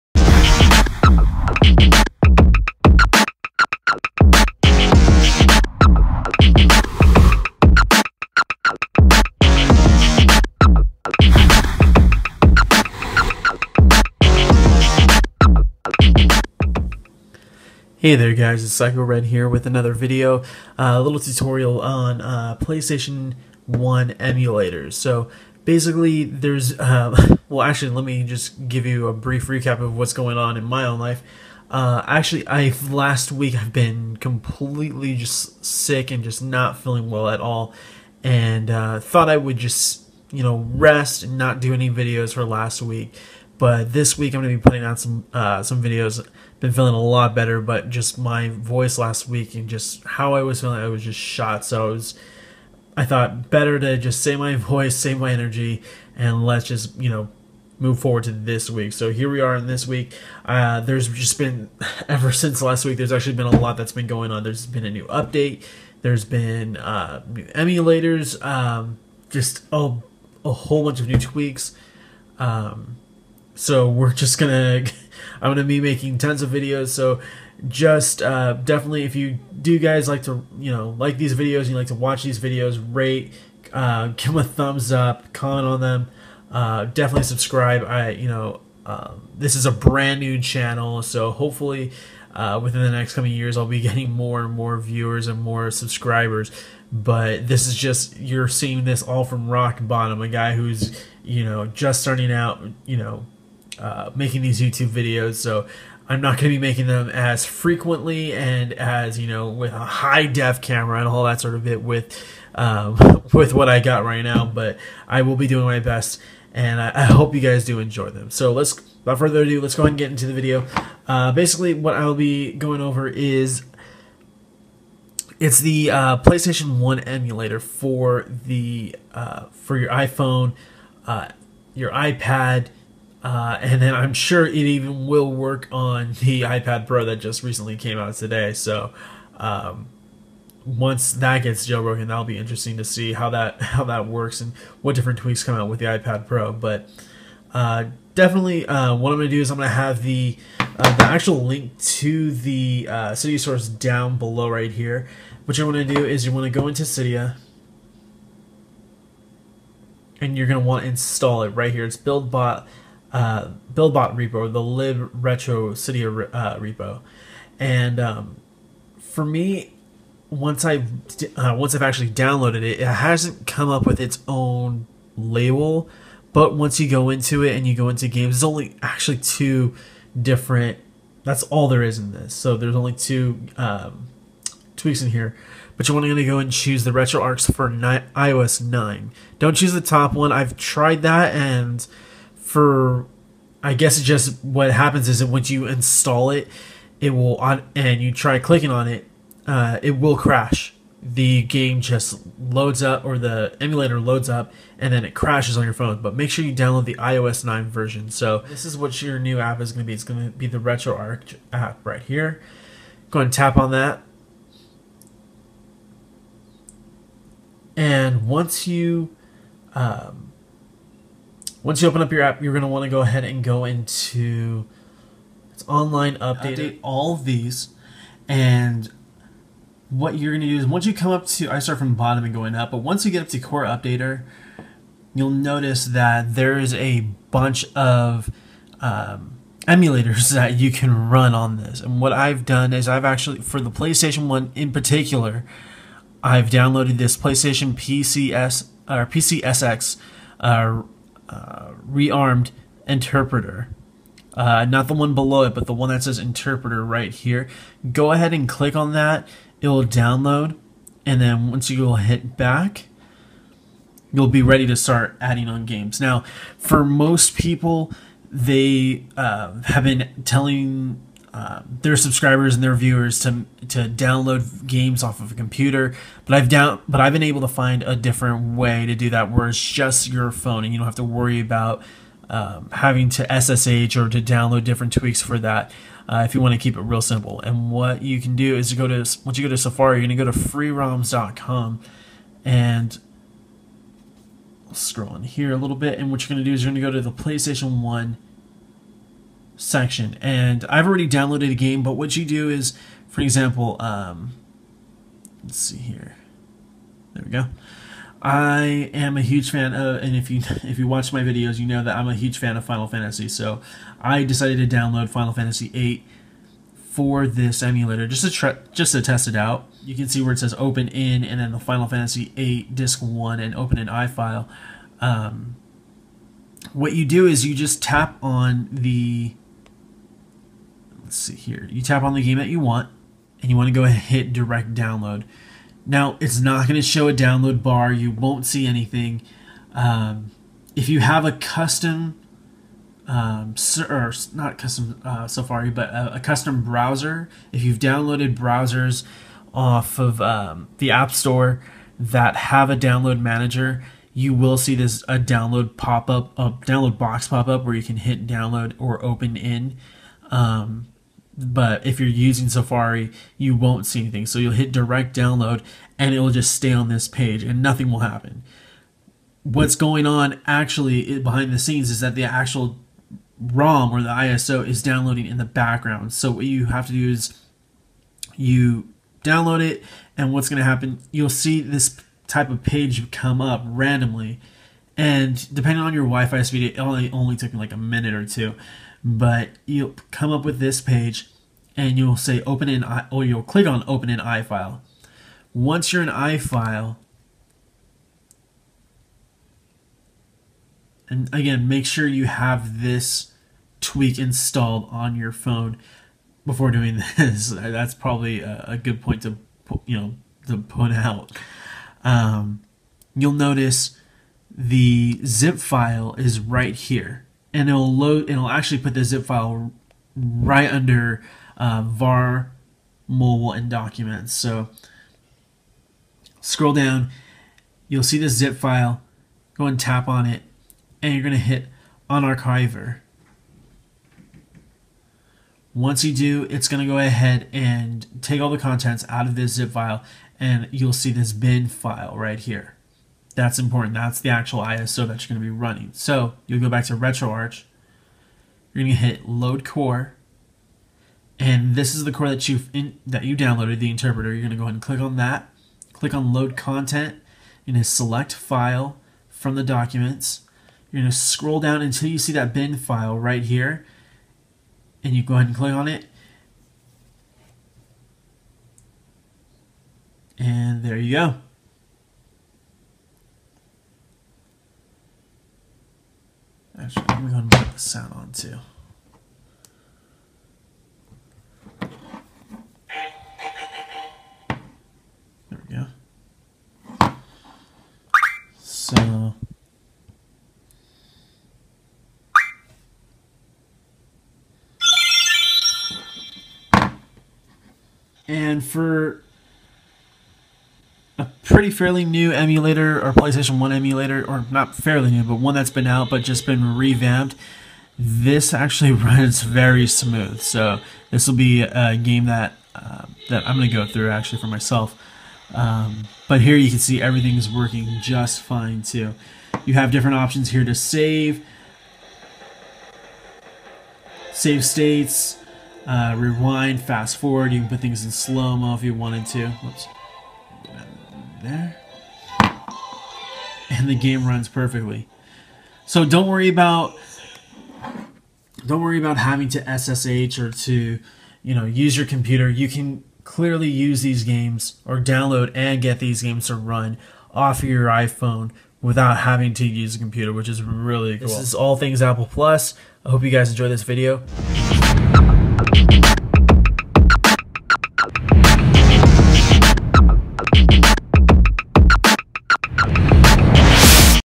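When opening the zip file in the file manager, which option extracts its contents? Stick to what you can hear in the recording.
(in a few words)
unarchiver.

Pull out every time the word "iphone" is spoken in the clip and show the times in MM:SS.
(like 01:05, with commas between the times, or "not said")
02:09, 09:07.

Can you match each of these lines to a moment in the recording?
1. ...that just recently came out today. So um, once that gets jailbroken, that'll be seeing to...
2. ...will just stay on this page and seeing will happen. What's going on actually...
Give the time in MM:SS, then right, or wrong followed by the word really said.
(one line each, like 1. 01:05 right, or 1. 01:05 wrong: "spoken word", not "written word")
1. 02:17 wrong: "interesting", not "seeing"
2. 06:06 wrong: "nothing", not "seeing".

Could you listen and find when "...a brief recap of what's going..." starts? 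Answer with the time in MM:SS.
00:29.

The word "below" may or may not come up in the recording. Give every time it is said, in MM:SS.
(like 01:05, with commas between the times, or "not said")
02:34, 04:15.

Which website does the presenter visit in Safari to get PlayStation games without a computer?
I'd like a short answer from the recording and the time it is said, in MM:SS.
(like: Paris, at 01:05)
freeroms.com, at 04:50.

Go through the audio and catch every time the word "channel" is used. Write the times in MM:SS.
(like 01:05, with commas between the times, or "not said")
01:30.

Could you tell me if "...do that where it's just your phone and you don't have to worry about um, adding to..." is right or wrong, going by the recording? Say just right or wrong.
wrong.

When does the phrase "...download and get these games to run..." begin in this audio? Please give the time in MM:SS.
09:04.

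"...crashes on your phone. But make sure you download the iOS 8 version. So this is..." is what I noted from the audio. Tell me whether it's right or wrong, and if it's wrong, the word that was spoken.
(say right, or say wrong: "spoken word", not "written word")
wrong: "9", not "8".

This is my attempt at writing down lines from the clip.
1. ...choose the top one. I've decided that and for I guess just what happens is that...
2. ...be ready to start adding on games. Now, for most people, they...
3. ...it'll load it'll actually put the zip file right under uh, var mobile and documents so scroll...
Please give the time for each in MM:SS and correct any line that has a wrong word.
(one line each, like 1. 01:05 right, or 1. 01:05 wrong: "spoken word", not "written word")
1. 03:09 wrong: "tried", not "decided"
2. 04:24 right
3. 06:57 right.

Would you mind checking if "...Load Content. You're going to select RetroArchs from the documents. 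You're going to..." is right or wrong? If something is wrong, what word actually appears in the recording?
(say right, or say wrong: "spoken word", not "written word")
wrong: "File", not "RetroArchs".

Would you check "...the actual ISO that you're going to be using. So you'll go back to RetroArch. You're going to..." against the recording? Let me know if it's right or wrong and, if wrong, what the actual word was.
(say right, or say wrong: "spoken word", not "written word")
wrong: "running", not "using".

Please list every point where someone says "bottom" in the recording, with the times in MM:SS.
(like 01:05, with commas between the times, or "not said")
01:39, 03:51.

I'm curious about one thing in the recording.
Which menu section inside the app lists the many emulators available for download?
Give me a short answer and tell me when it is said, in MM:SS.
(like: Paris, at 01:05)
core updater, at 03:53.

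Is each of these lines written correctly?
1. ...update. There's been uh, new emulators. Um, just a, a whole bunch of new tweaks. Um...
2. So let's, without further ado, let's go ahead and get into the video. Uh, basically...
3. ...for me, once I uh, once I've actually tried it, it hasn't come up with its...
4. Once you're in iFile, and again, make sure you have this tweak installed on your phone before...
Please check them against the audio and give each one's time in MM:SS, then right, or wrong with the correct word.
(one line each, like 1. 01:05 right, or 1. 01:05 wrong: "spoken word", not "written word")
1. 01:05 right
2. 01:58 right
3. 02:48 wrong: "downloaded", not "tried"
4. 06:35 right.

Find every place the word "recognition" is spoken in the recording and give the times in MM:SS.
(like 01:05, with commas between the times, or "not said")
not said.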